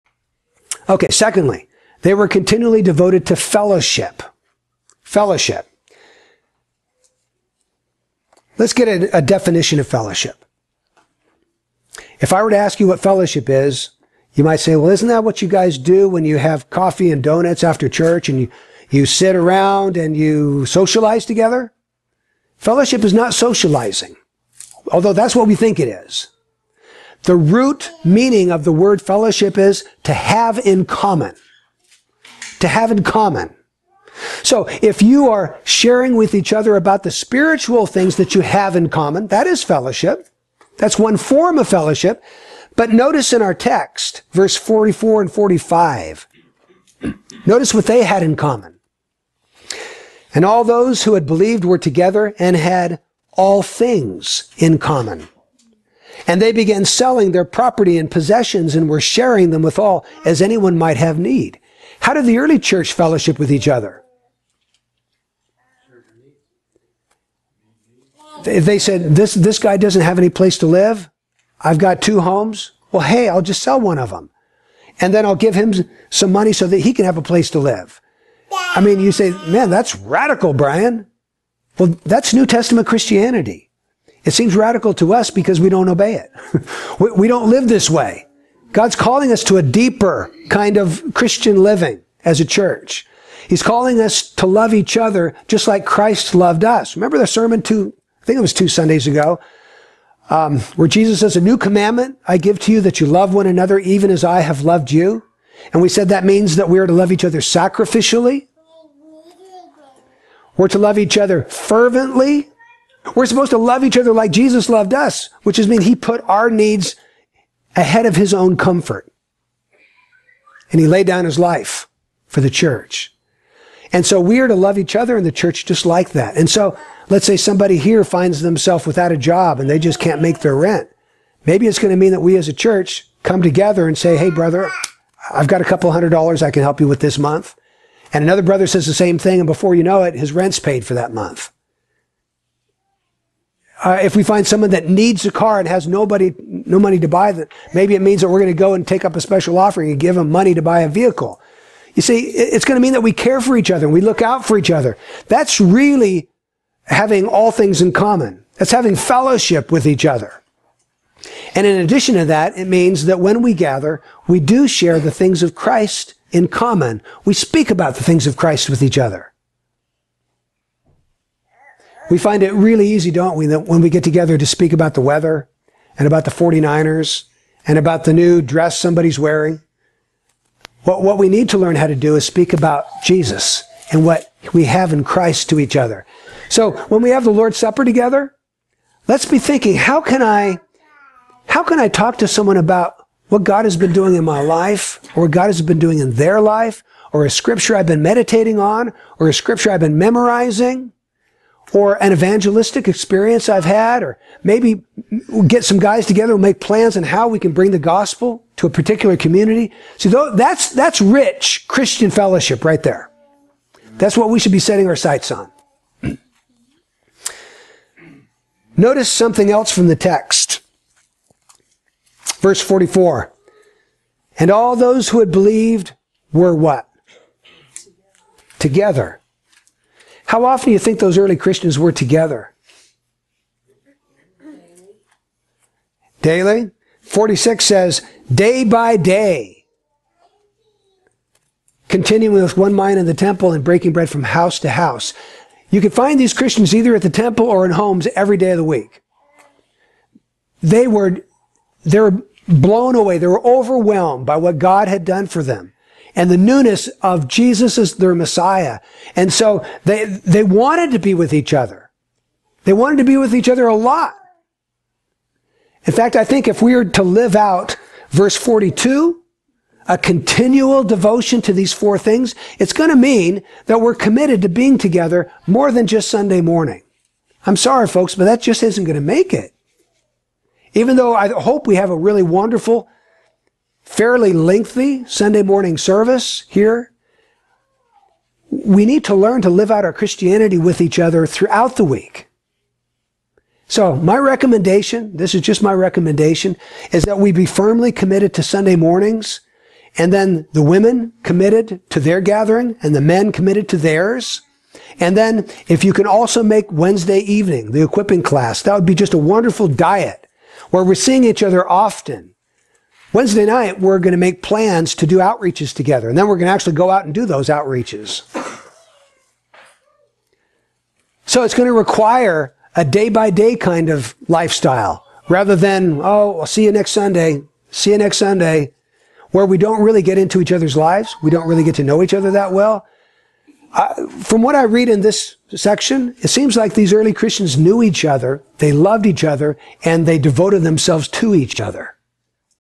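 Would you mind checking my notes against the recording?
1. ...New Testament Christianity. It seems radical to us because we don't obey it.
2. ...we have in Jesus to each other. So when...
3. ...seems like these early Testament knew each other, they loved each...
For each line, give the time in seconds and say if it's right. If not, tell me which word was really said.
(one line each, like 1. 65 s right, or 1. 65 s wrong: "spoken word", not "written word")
1. 82 s right
2. 184 s wrong: "Christ", not "Jesus"
3. 336 s wrong: "Christians", not "Testament".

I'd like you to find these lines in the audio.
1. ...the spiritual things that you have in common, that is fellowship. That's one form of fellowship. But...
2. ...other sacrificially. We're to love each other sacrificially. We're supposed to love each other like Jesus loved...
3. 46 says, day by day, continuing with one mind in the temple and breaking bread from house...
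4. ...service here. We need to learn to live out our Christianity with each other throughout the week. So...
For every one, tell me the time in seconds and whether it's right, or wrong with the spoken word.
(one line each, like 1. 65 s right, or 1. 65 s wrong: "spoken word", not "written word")
1. 37 s right
2. 107 s wrong: "fervently", not "sacrificially"
3. 237 s right
4. 285 s right.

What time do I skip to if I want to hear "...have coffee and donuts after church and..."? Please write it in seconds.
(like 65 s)
16 s.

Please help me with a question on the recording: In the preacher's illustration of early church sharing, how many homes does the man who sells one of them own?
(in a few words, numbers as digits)
2.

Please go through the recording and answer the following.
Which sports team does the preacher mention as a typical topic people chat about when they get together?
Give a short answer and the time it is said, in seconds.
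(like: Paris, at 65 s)
49ers, at 176 s.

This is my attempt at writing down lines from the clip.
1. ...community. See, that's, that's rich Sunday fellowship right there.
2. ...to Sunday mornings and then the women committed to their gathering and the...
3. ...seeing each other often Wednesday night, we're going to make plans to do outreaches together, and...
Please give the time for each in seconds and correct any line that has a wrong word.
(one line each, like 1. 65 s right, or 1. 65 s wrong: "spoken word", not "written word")
1. 209 s wrong: "Christian", not "Sunday"
2. 298 s right
3. 310 s right.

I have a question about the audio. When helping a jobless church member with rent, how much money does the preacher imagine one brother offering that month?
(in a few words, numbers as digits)
A couple hundred dollars.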